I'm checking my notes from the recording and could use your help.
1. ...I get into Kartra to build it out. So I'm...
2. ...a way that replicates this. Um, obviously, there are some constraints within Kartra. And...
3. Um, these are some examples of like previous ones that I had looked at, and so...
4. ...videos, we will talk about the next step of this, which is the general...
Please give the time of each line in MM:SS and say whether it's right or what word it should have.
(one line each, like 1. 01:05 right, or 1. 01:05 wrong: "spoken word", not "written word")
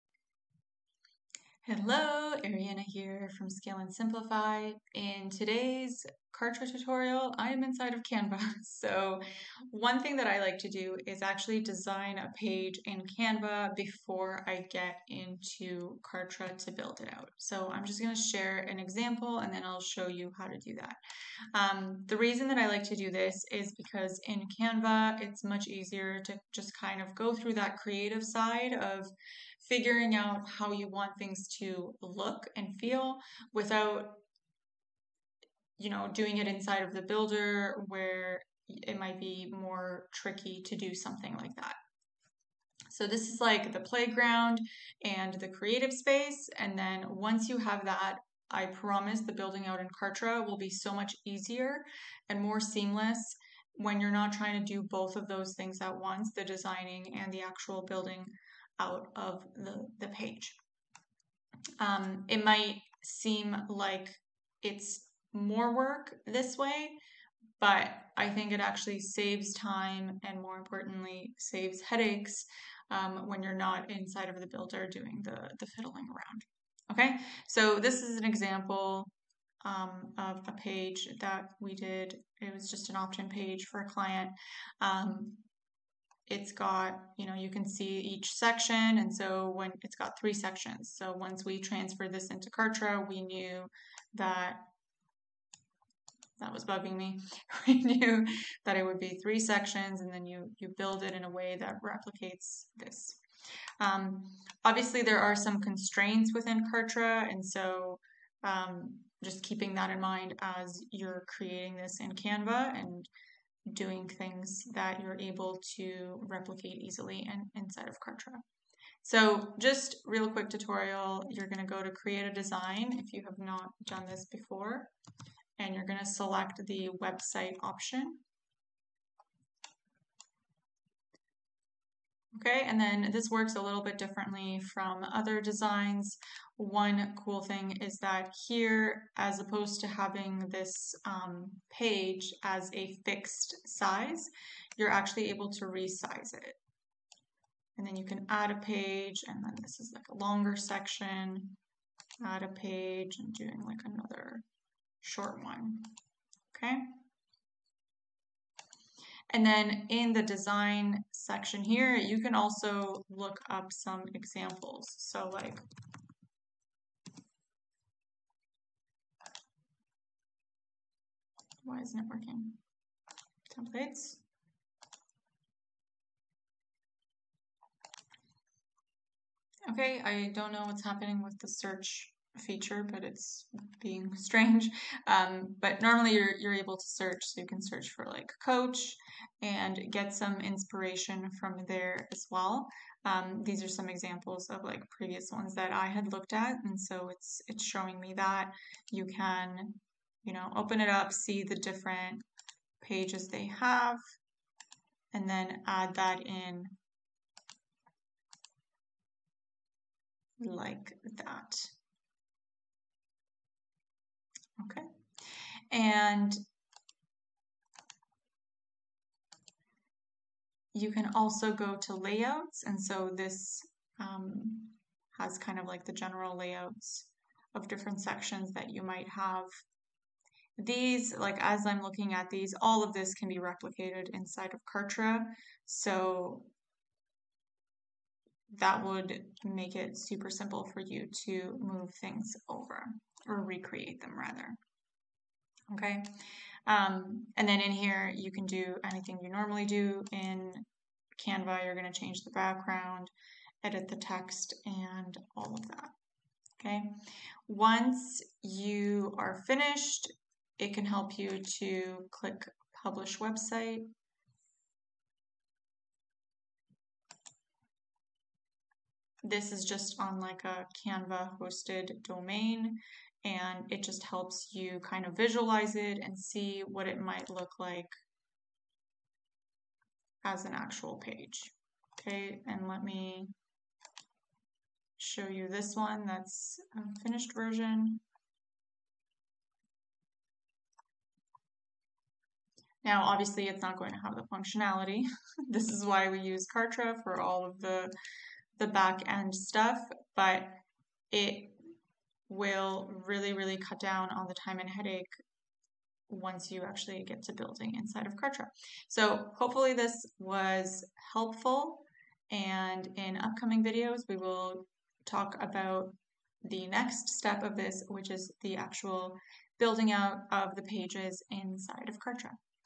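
1. 00:14 right
2. 01:41 right
3. 03:13 right
4. 05:13 wrong: "actual", not "general".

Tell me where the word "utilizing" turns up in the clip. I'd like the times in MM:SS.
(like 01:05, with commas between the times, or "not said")
not said.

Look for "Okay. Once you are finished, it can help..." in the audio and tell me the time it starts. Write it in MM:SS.
04:16.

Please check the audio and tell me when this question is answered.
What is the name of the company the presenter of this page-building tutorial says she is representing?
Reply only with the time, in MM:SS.
00:03.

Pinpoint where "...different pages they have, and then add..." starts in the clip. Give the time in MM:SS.
03:21.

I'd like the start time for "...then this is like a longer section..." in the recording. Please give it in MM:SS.
02:29.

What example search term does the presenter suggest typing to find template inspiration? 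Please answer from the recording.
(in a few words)
coach.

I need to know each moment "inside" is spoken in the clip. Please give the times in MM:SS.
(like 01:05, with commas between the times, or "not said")
00:07, 00:36, 01:13, 01:57, 03:54, 05:07, 05:21.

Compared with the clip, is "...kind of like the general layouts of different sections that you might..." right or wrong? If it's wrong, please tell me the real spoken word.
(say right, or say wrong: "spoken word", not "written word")
right.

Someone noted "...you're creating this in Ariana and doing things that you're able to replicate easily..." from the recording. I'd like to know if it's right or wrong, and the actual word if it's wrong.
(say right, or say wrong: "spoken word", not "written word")
wrong: "Canva", not "Ariana".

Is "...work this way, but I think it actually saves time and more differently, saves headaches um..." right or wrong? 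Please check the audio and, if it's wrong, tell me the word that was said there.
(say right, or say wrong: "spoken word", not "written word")
wrong: "importantly", not "differently".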